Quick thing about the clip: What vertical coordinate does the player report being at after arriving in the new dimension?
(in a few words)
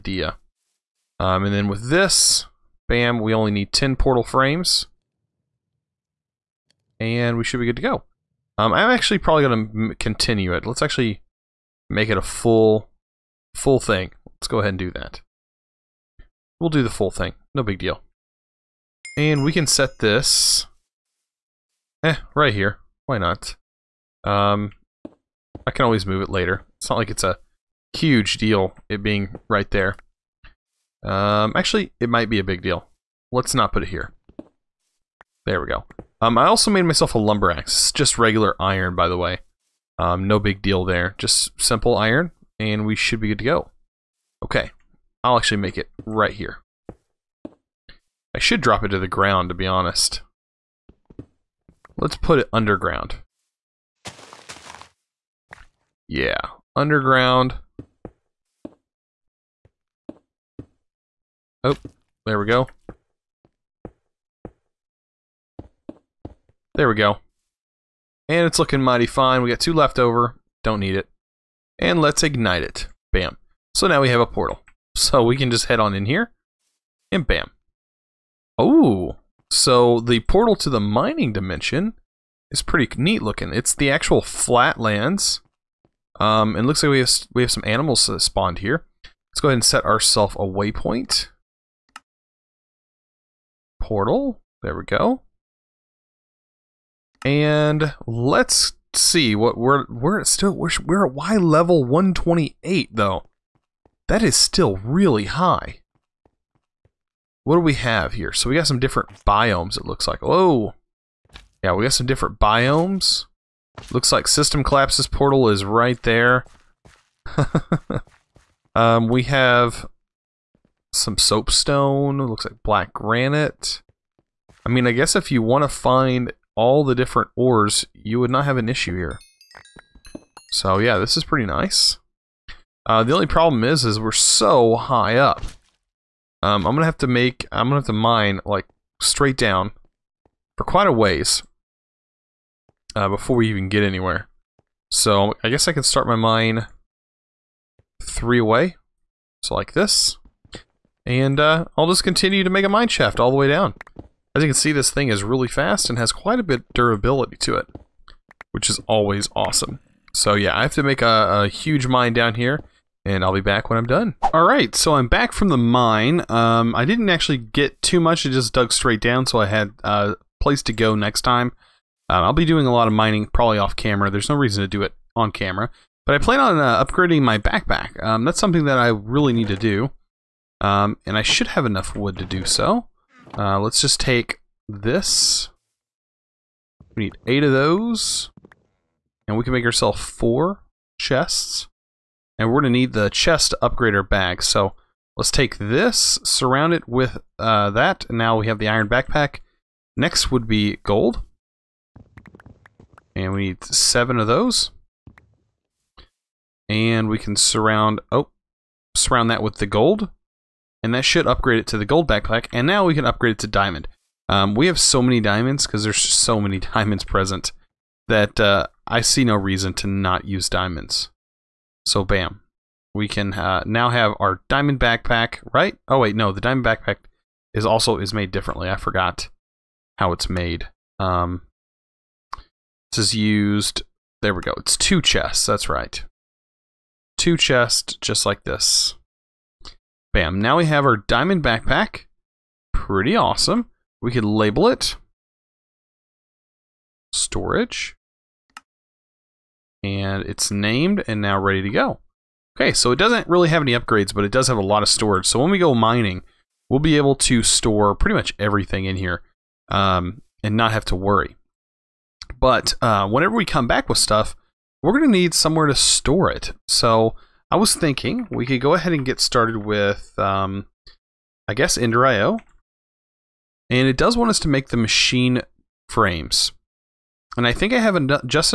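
128.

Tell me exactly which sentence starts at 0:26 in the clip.
It's not like it's a huge deal, it being right there.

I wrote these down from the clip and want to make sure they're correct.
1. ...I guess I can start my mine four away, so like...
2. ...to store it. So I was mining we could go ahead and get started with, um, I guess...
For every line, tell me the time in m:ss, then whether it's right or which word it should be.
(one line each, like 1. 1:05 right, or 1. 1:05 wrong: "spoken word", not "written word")
1. 2:25 wrong: "three", not "four"
2. 4:25 wrong: "thinking", not "mining".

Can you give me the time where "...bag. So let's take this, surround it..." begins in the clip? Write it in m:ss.
3:14.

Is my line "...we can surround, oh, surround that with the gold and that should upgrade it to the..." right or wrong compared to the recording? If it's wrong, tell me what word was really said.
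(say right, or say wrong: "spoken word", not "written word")
right.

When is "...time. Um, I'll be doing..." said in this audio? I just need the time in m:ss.
2:51.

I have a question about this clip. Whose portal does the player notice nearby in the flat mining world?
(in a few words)
System Collapse.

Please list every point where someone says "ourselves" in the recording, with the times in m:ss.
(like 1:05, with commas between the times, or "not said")
1:29, 3:09.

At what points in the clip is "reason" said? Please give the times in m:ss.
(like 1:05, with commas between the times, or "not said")
2:54, 3:39.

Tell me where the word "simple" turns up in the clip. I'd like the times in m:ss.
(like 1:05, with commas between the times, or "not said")
0:41.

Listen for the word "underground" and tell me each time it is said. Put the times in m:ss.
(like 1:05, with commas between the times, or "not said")
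0:52, 0:56.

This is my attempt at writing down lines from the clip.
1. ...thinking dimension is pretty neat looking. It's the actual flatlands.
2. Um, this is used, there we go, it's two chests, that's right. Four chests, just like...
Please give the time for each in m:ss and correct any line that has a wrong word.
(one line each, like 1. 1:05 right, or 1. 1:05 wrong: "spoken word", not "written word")
1. 1:20 wrong: "mining", not "thinking"
2. 3:50 wrong: "Two", not "Four".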